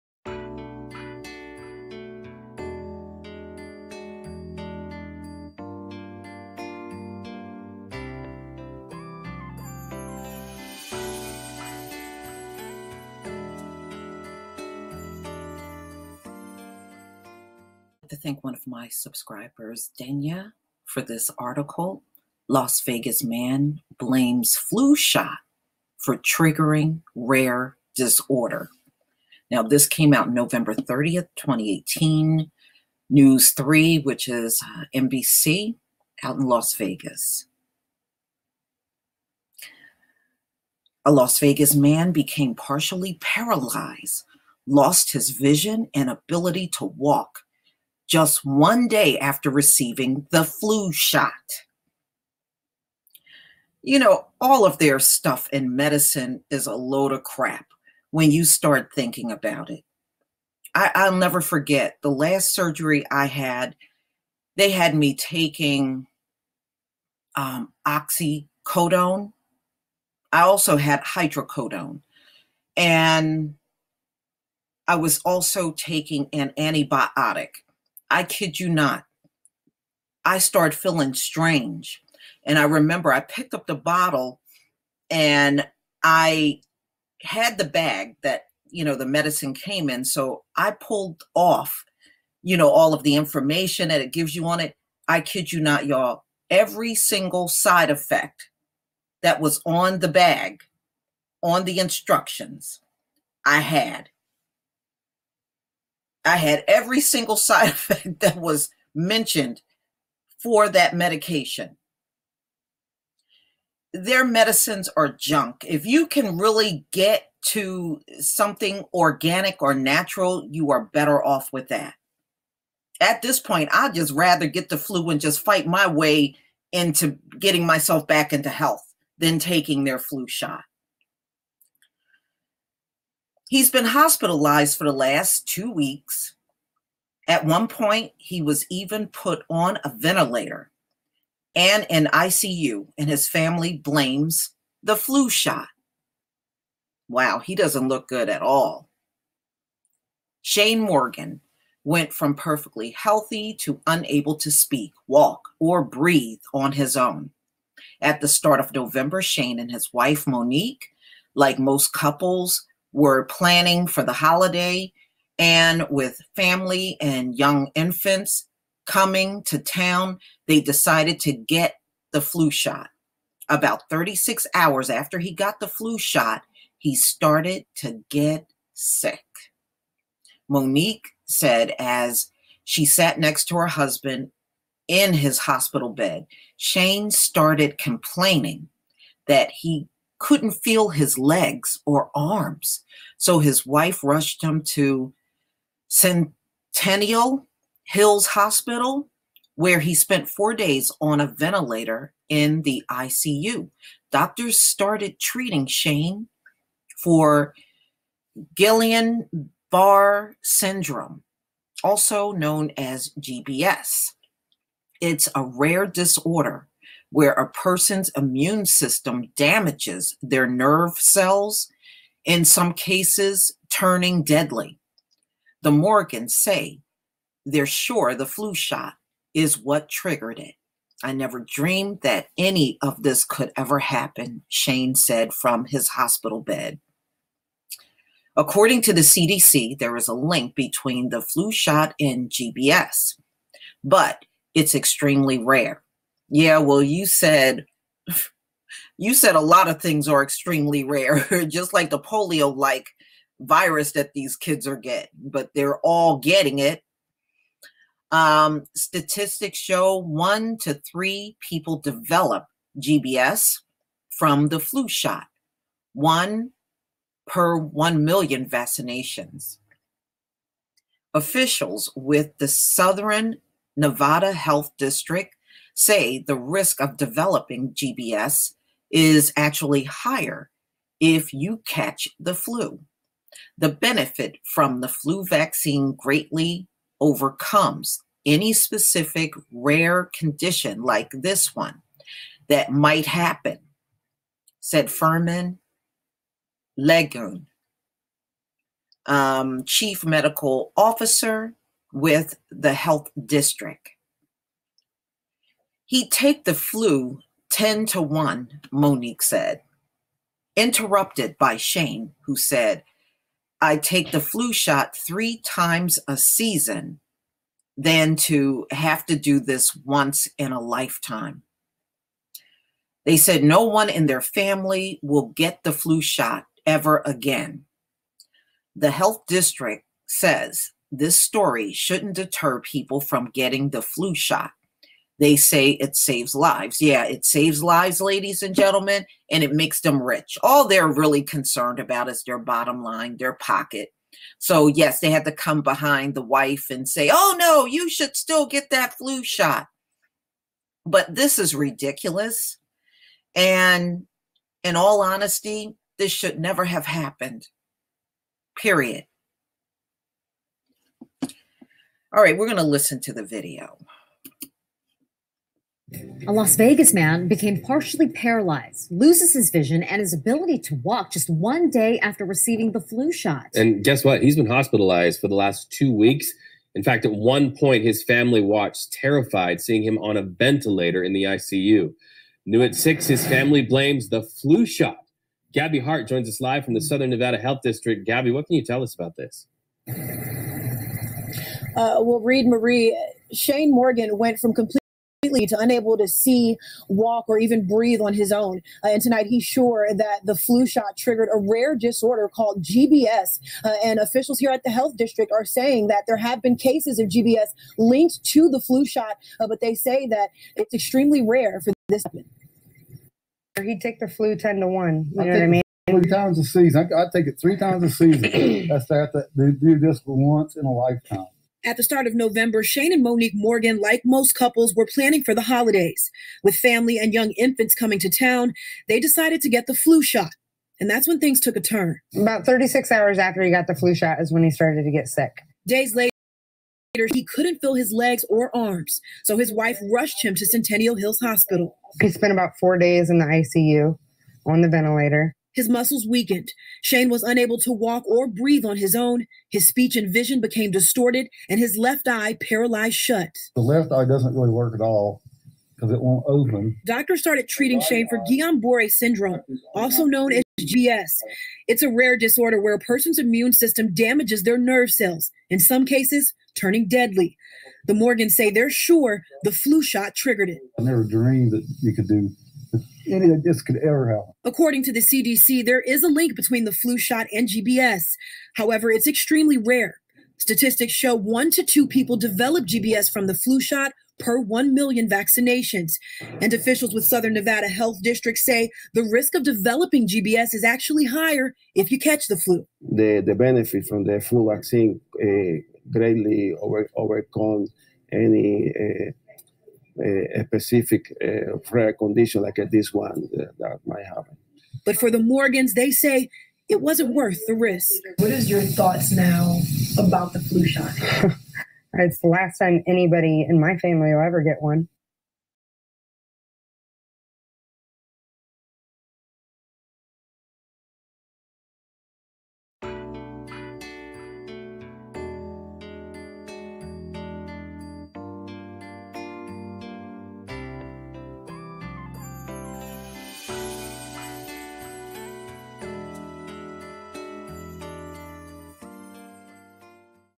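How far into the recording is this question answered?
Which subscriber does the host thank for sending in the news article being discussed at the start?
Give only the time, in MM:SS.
00:19.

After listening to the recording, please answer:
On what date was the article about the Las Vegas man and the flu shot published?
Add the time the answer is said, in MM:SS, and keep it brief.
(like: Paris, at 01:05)
November 30, 2018, at 00:30.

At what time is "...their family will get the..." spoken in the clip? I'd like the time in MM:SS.
05:24.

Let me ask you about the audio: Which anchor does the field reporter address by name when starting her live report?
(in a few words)
Reed Marie.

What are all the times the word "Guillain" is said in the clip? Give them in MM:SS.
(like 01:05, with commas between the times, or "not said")
03:28, 07:38.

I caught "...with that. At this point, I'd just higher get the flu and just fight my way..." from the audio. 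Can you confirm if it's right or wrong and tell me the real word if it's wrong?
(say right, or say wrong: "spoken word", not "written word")
wrong: "rather", not "higher".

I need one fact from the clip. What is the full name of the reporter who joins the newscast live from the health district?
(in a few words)
Gabby Hart.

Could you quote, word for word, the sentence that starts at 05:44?
So, yes, they had to come behind the wife and say, oh, no, you should still get that flu shot.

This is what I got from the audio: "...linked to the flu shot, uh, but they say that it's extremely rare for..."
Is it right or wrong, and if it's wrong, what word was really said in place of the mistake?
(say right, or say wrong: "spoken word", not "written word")
right.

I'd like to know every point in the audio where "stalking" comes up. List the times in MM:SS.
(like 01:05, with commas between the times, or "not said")
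not said.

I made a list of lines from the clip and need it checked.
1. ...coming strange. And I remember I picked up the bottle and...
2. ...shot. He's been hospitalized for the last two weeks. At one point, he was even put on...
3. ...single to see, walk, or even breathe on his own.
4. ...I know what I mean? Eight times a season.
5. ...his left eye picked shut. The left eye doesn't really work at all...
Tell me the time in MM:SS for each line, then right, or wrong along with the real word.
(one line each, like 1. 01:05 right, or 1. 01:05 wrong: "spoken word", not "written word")
1. 01:20 wrong: "feeling", not "coming"
2. 02:10 right
3. 06:35 wrong: "unable", not "single"
4. 06:55 wrong: "Three", not "Eight"
5. 07:31 wrong: "paralyzed", not "picked".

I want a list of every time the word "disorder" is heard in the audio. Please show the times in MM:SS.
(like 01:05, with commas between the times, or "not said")
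00:27, 03:35, 06:41, 07:42.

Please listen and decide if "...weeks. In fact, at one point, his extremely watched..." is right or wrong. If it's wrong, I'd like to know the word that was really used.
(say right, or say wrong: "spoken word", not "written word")
wrong: "family", not "extremely".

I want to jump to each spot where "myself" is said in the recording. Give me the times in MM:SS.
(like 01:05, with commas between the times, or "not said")
02:07.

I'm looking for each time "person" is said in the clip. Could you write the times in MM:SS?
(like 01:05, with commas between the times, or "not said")
03:37, 07:42.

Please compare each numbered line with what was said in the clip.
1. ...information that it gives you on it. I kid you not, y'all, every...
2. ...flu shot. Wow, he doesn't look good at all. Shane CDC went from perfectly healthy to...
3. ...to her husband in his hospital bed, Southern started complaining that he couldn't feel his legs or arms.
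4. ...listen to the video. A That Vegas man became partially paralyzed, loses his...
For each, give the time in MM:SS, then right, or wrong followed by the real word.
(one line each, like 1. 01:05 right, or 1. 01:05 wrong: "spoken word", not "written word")
1. 01:33 right
2. 02:24 wrong: "Morgan", not "CDC"
3. 03:03 wrong: "Shane", not "Southern"
4. 06:02 wrong: "Las", not "That".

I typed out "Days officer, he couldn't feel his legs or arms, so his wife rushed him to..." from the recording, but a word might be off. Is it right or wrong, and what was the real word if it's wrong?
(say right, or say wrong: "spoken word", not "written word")
wrong: "later", not "officer".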